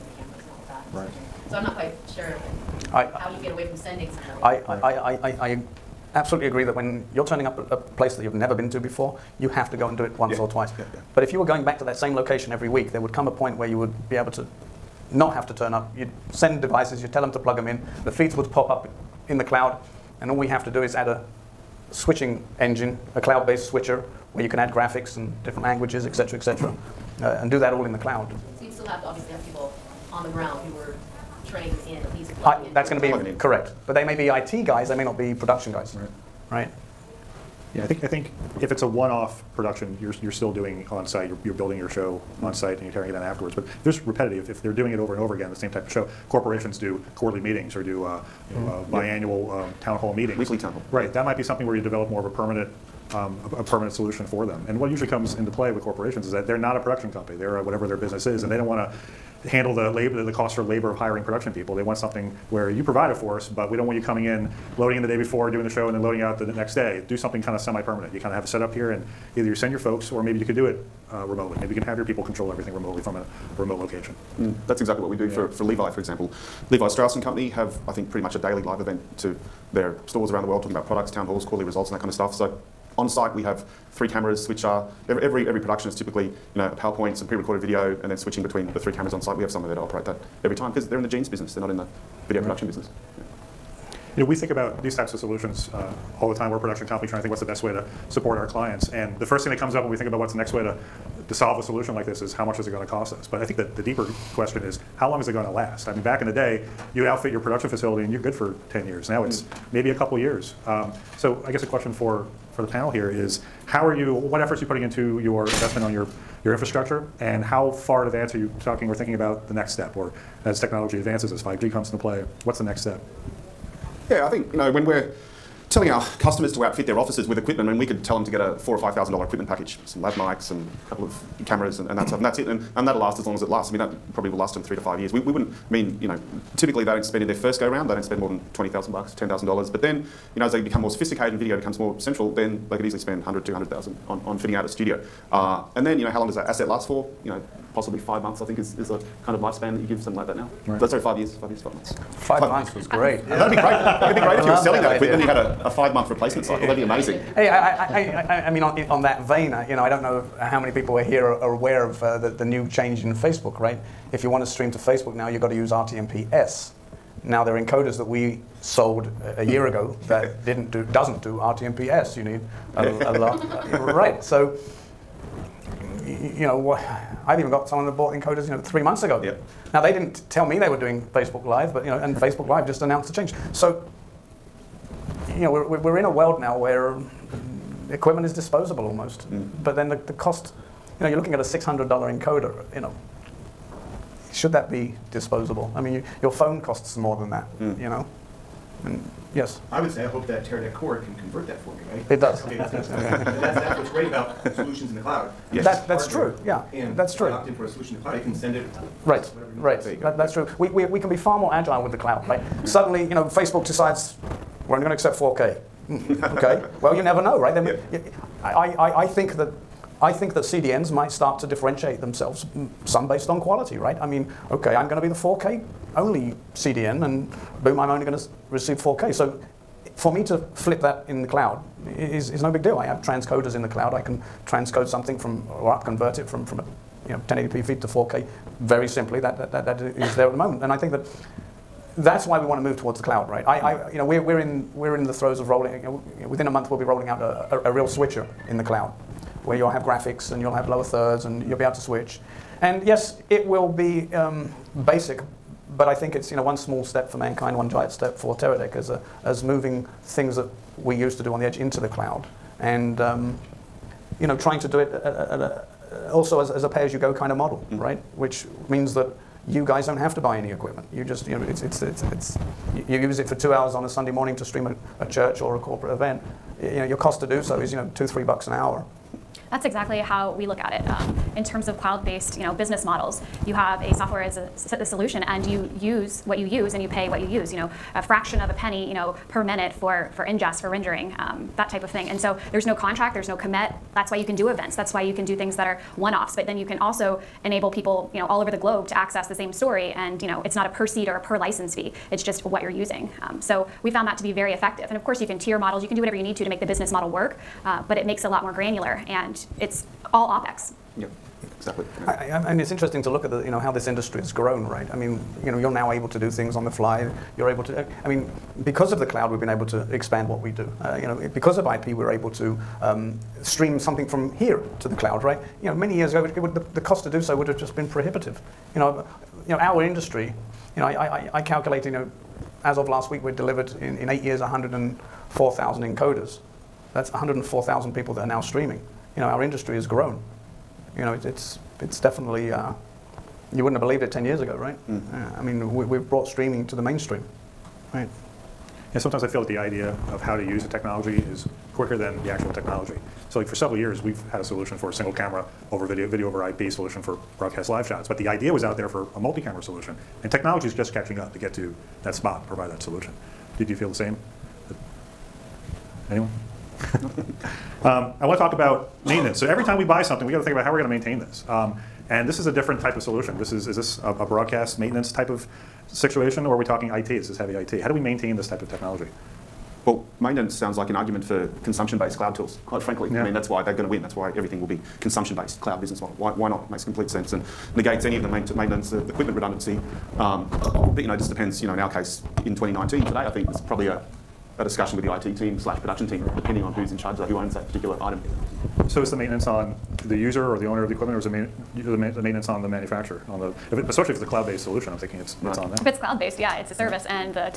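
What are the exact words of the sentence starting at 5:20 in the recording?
Uh, you know, because of IP, we're able to um, stream something from here to the cloud, right?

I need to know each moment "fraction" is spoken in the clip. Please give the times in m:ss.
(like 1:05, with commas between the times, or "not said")
4:47.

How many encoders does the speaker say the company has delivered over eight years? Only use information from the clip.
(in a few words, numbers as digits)
104,000.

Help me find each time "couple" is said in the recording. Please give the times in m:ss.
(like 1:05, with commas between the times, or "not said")
1:49, 2:10.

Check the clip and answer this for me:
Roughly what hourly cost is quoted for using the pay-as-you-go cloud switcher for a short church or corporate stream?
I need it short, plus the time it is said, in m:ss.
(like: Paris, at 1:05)
2 to 3 dollars, at 4:37.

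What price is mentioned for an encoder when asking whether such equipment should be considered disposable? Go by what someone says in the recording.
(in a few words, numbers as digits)
$600.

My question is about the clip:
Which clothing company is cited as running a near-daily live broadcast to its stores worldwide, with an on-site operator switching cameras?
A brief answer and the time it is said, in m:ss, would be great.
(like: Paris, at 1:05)
Levi Strauss and Company, at 1:16.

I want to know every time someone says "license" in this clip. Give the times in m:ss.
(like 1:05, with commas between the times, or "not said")
5:01.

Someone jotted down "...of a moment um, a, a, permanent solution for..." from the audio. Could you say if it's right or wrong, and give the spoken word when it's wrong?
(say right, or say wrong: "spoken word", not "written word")
wrong: "permanent", not "moment".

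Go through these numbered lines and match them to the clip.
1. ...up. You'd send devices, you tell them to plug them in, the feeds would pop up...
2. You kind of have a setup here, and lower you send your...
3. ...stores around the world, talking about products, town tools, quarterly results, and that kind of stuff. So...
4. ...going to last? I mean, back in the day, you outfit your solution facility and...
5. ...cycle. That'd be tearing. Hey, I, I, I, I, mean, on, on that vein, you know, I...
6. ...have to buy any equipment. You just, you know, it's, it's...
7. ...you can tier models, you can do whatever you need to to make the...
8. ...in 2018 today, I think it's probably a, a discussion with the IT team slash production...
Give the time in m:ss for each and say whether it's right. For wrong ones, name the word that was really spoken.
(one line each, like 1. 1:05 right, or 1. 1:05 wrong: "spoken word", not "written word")
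1. 0:15 right
2. 1:08 wrong: "either", not "lower"
3. 1:20 wrong: "halls", not "tools"
4. 1:45 wrong: "production", not "solution"
5. 2:36 wrong: "amazing", not "tearing"
6. 4:29 right
7. 5:05 right
8. 6:32 wrong: "2019", not "2018".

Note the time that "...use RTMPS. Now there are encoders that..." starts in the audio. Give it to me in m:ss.
2:45.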